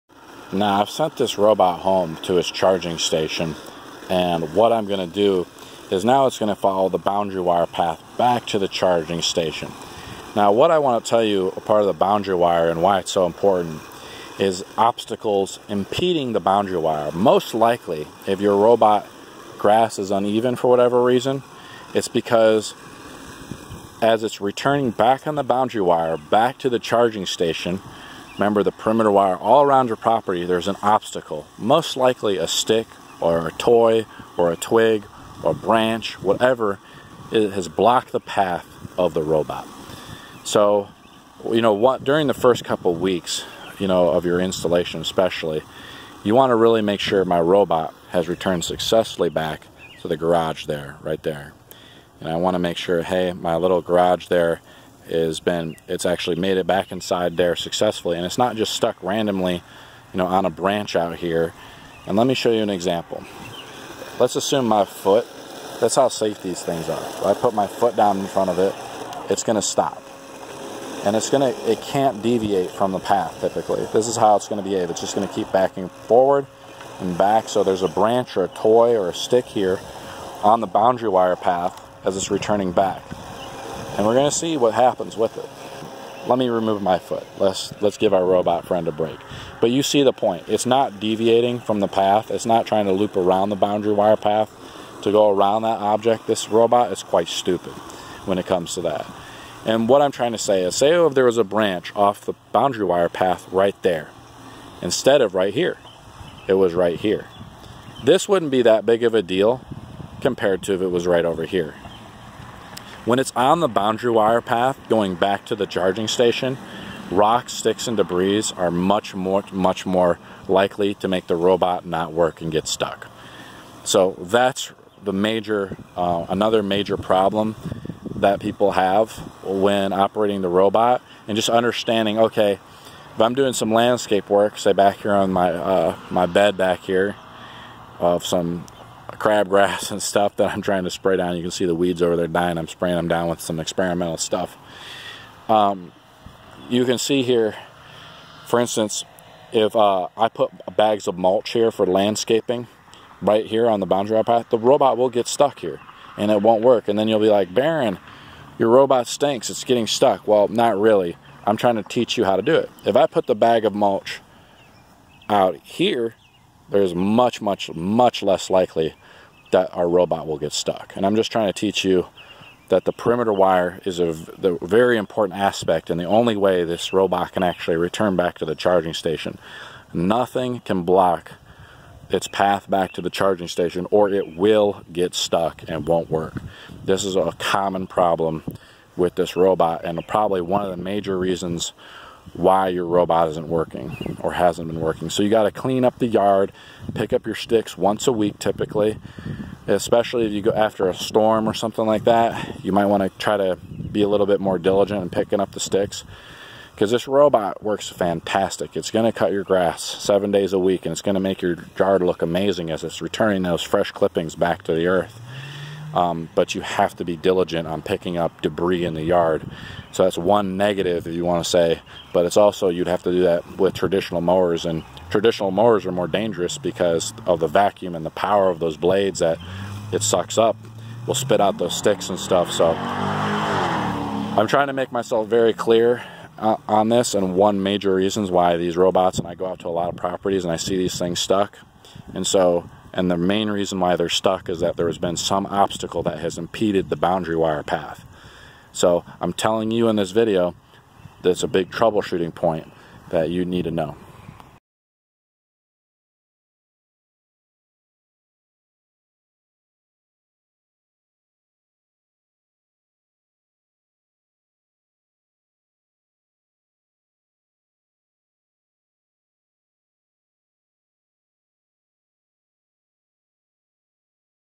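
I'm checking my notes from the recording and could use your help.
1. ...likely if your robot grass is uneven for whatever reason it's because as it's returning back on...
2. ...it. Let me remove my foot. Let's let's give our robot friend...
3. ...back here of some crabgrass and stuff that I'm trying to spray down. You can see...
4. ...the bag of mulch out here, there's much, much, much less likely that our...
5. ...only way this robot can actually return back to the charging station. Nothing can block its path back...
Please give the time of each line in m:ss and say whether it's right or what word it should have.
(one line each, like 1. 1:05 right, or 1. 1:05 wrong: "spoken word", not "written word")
1. 0:17 right
2. 1:25 right
3. 2:16 right
4. 2:43 right
5. 2:56 right.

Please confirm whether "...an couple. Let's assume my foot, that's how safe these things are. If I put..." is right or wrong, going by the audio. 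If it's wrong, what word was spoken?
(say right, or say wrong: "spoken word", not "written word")
wrong: "example", not "couple".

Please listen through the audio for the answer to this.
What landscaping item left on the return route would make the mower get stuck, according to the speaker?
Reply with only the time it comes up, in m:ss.
2:30.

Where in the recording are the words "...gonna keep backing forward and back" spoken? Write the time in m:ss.
1:15.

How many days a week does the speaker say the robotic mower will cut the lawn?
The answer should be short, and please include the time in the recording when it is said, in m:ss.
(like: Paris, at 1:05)
7, at 3:29.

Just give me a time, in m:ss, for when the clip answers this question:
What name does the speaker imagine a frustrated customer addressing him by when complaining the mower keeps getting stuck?
2:37.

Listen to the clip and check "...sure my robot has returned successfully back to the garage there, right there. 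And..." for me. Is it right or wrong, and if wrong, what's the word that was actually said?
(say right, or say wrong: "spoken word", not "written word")
right.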